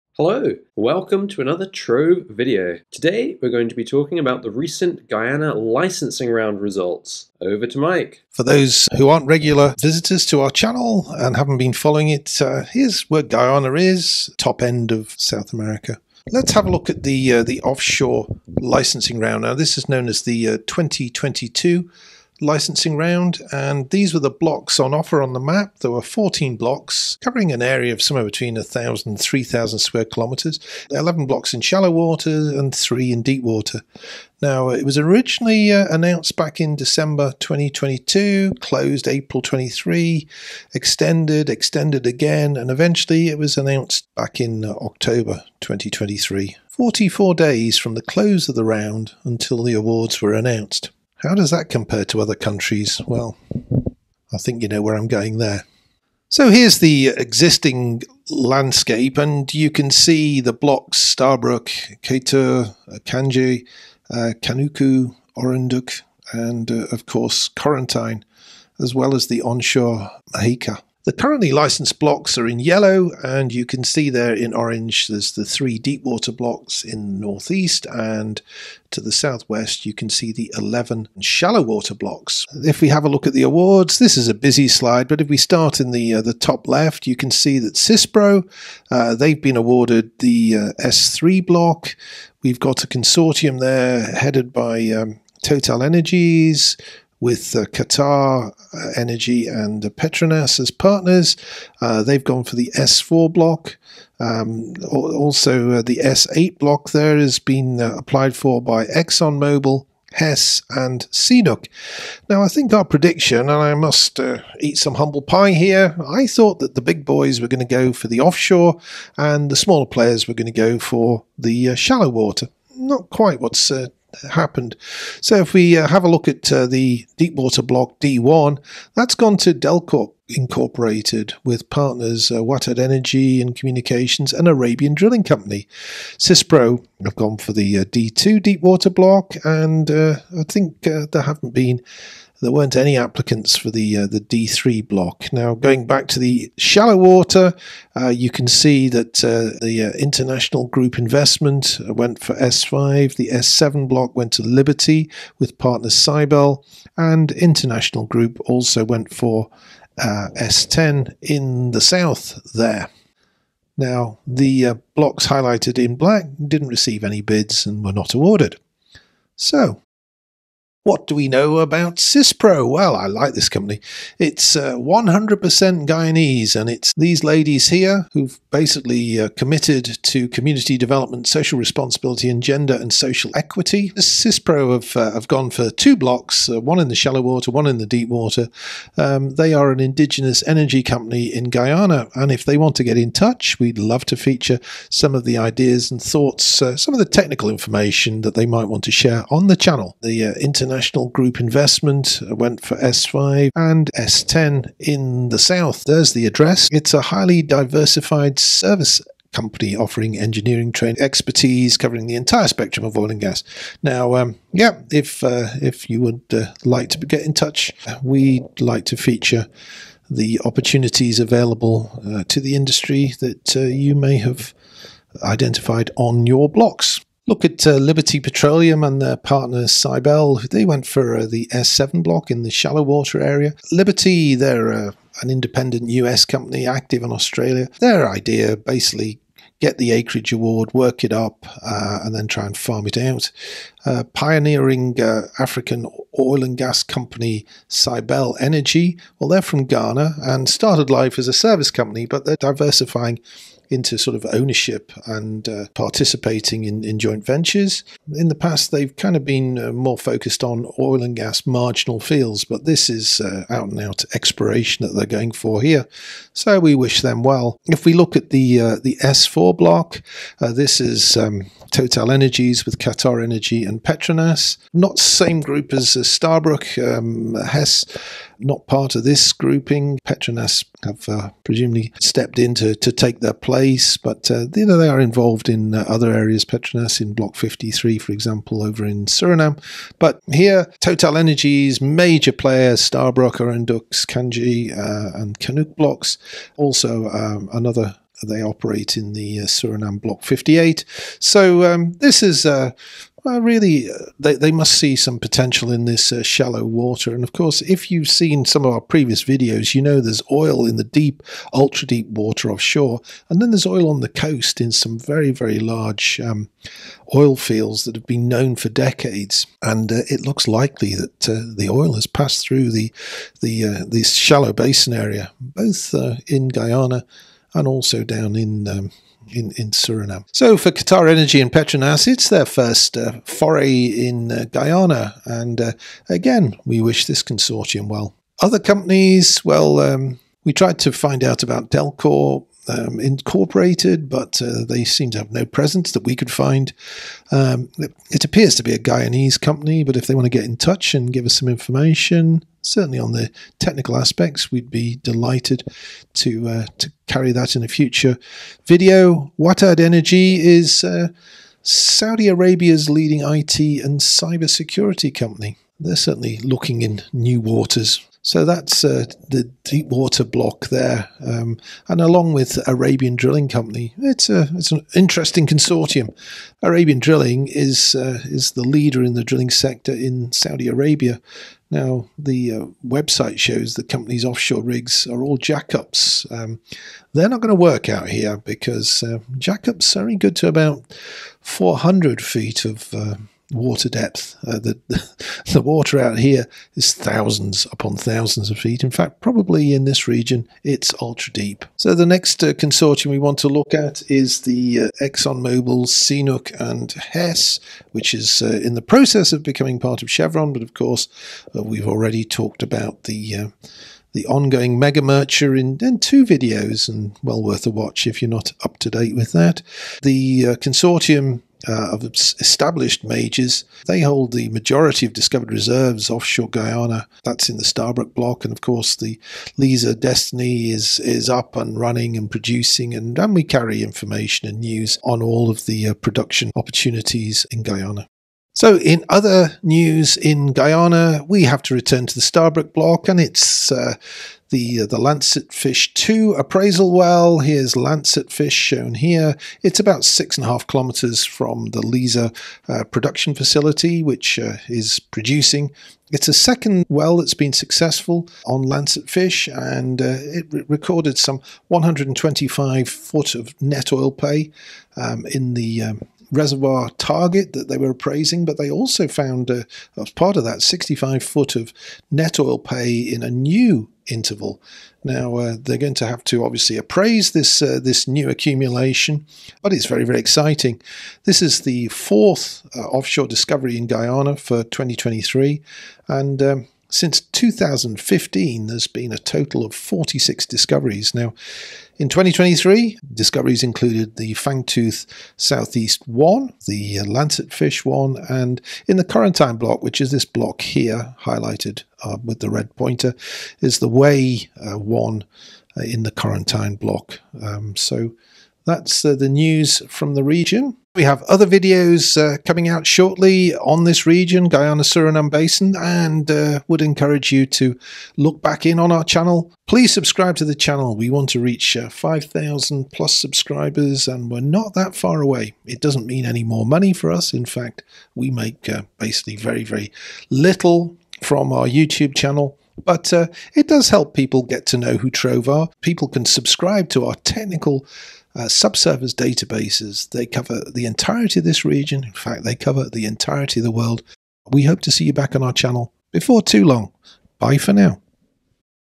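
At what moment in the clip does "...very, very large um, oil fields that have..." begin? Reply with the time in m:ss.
5:14.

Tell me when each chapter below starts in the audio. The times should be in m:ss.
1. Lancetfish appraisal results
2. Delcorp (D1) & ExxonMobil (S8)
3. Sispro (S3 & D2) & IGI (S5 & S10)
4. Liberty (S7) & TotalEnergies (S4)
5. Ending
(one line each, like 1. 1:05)
1. 7:18
2. 5:38
3. 2:50
4. 3:47
5. 8:30.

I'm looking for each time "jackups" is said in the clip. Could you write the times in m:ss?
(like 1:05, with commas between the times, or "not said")
6:25, 6:29.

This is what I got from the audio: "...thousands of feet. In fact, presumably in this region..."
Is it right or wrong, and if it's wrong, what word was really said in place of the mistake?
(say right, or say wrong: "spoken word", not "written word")
wrong: "probably", not "presumably".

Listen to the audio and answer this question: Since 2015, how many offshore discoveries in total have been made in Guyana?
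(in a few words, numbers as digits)
46.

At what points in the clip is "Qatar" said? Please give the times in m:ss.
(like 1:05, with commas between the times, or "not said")
1:37, 4:32, 5:30.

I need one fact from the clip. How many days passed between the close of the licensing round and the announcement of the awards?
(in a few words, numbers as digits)
44.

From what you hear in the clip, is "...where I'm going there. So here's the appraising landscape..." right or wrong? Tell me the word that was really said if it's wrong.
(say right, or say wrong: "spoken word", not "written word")
wrong: "existing", not "appraising".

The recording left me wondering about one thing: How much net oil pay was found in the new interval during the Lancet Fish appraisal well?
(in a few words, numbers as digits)
65 feet.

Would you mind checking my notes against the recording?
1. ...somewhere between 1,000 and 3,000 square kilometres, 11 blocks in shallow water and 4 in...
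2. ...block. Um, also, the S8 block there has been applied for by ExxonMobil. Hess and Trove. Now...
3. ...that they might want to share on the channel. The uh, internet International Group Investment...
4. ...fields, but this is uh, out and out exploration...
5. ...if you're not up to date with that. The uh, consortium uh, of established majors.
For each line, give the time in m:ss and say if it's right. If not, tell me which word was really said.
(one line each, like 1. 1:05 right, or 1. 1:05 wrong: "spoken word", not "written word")
1. 0:28 wrong: "3", not "4"
2. 1:43 wrong: "CNOOC", not "Trove"
3. 3:18 right
4. 4:21 right
5. 6:58 right.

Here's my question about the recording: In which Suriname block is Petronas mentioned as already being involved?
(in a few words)
Block 53.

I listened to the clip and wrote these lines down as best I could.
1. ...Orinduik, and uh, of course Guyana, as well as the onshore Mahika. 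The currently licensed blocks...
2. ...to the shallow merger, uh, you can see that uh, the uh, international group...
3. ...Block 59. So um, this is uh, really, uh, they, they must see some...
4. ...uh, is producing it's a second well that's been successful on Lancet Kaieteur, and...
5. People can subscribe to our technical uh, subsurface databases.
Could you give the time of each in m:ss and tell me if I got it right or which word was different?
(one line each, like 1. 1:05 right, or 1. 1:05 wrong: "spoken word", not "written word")
1. 1:05 wrong: "Corentyne", not "Guyana"
2. 2:26 wrong: "water", not "merger"
3. 5:00 wrong: "58", not "59"
4. 7:34 wrong: "Fish", not "Kaieteur"
5. 8:55 right.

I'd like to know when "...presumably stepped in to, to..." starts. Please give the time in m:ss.
4:41.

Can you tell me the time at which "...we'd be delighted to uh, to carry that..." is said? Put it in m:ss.
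5:54.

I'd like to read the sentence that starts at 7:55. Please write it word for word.
Now uh, they're going to have to obviously appraise this uh, this new accumulation, but it's very very exciting.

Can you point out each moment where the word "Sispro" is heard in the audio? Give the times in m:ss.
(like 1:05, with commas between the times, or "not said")
1:27, 2:16, 2:51, 3:03.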